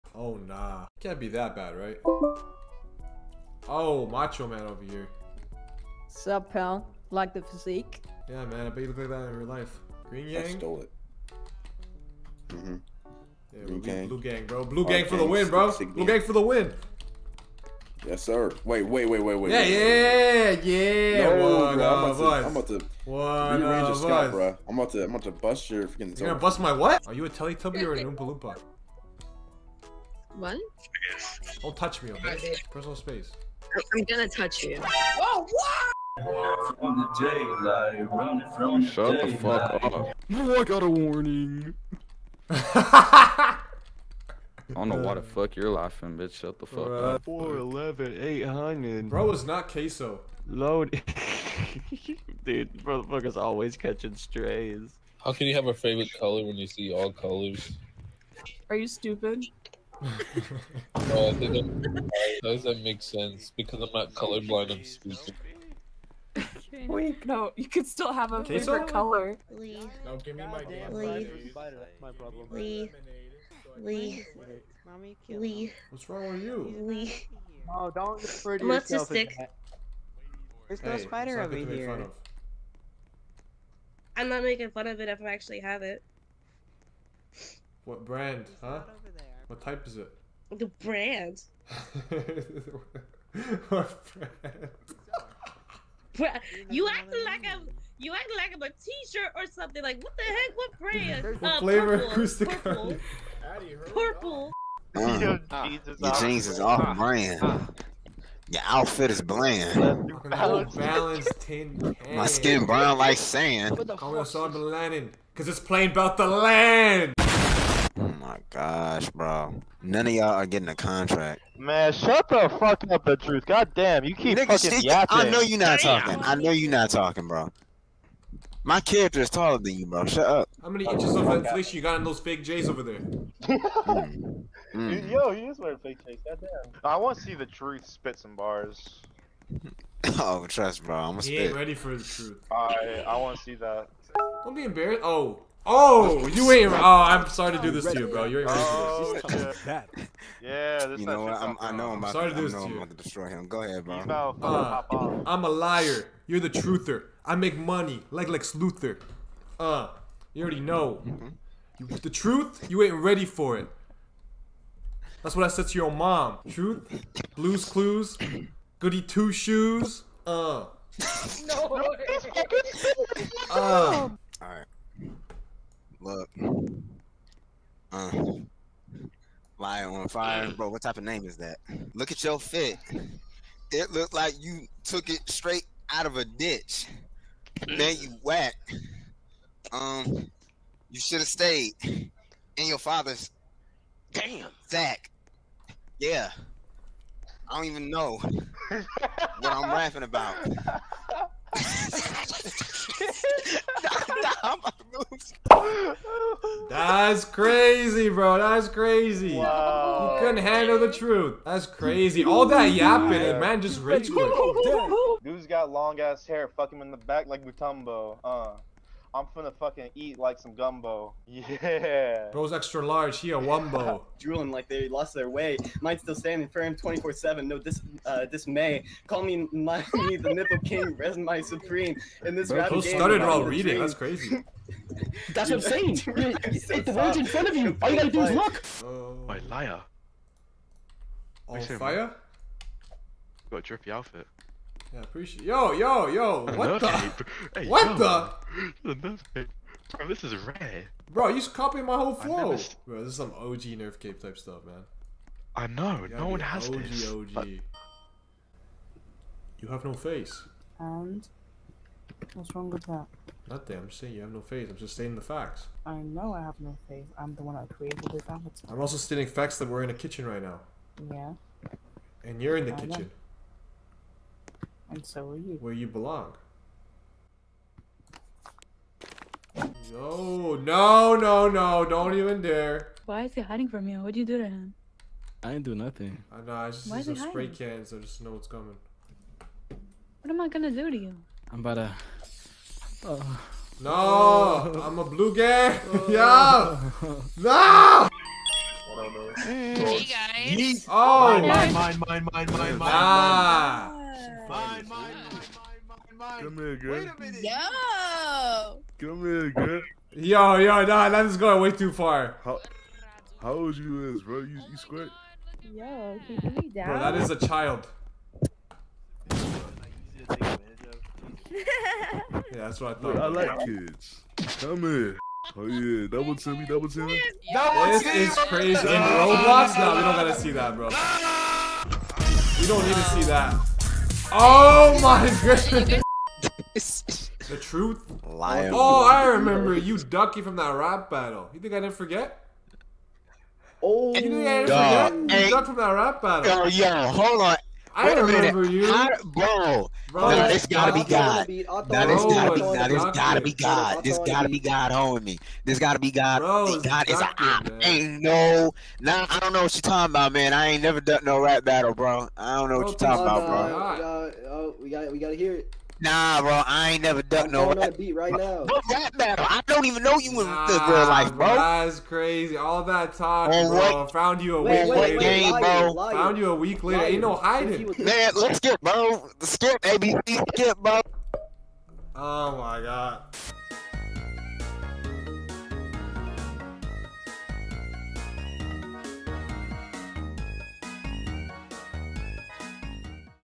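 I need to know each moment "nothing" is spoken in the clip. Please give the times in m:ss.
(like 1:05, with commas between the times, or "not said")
4:23, 4:45.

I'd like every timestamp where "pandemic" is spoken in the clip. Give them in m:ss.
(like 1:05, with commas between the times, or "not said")
not said.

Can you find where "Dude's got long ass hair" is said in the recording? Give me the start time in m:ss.
3:35.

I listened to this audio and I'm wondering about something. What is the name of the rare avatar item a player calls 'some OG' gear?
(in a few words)
Nerf Cape.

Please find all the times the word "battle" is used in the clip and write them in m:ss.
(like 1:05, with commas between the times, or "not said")
5:41, 5:46, 6:01, 6:09.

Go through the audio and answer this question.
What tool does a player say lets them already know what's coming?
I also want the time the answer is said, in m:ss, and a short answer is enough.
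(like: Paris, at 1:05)
spray can, at 4:47.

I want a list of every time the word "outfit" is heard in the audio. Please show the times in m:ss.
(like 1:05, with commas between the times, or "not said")
1:48, 4:03.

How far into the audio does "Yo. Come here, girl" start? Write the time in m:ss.
5:07.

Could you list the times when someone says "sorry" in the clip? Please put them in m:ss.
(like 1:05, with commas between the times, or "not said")
2:27, 2:32.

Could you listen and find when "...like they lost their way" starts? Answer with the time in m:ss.
3:44.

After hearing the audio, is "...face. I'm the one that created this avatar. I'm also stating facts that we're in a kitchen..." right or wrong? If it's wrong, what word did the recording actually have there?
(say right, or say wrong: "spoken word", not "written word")
right.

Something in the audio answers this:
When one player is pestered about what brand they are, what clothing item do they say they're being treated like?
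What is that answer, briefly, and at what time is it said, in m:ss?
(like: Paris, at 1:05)
T-shirt, at 1:38.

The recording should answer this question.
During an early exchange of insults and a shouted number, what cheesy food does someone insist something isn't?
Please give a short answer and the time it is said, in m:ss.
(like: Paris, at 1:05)
queso, at 0:49.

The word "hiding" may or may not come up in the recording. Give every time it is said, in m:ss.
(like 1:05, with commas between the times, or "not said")
4:43, 6:17.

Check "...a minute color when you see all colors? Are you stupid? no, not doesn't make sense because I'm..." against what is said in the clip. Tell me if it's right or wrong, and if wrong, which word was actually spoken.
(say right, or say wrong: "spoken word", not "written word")
wrong: "favorite", not "minute".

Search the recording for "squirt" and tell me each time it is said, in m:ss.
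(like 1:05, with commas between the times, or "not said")
5:14.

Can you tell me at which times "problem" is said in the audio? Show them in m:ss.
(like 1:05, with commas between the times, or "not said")
1:12.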